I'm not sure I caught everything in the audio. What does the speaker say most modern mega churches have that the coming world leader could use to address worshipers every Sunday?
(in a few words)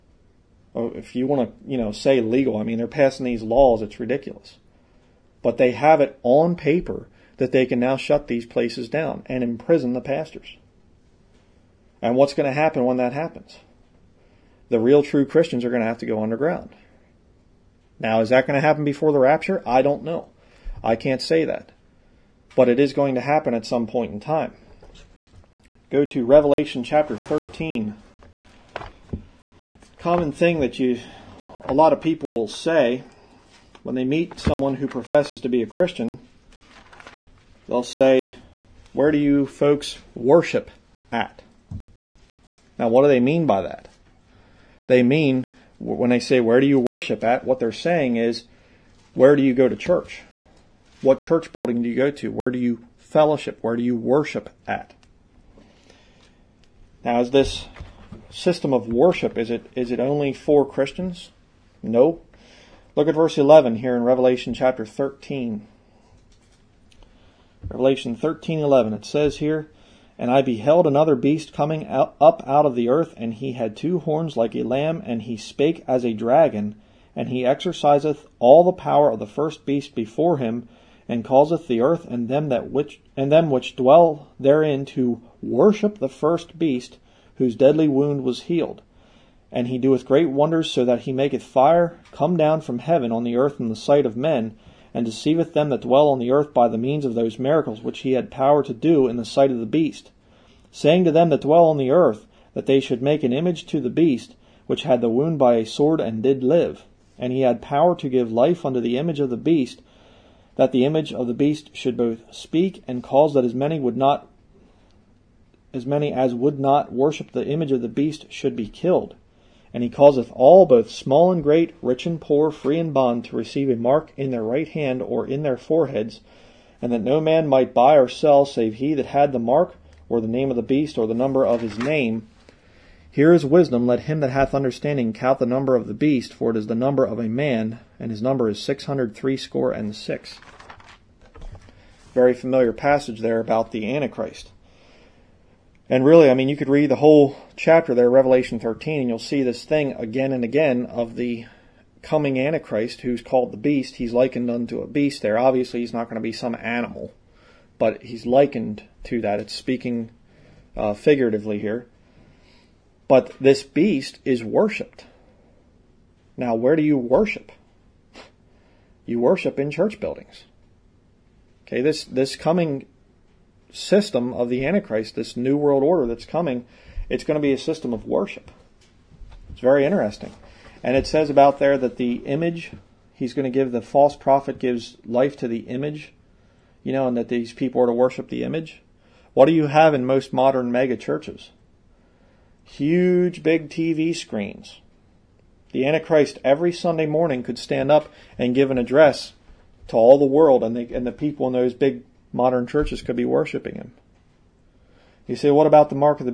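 huge big TV screens.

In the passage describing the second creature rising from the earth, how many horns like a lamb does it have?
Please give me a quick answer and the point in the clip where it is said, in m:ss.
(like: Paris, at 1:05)
2, at 1:13.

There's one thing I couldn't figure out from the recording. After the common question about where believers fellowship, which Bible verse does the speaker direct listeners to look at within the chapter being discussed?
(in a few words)
verse 11.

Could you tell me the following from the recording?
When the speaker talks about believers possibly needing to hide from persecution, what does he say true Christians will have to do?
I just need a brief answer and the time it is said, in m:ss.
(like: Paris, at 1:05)
go underground, at 0:16.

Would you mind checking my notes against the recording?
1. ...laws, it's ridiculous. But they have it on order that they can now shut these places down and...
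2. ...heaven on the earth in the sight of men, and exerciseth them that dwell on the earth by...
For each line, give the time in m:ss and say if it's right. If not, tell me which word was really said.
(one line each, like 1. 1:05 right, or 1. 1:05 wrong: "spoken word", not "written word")
1. 0:03 wrong: "paper", not "order"
2. 1:32 wrong: "deceiveth", not "exerciseth".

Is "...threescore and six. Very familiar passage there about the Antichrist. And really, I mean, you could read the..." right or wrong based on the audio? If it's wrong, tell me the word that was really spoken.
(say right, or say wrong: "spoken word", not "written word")
right.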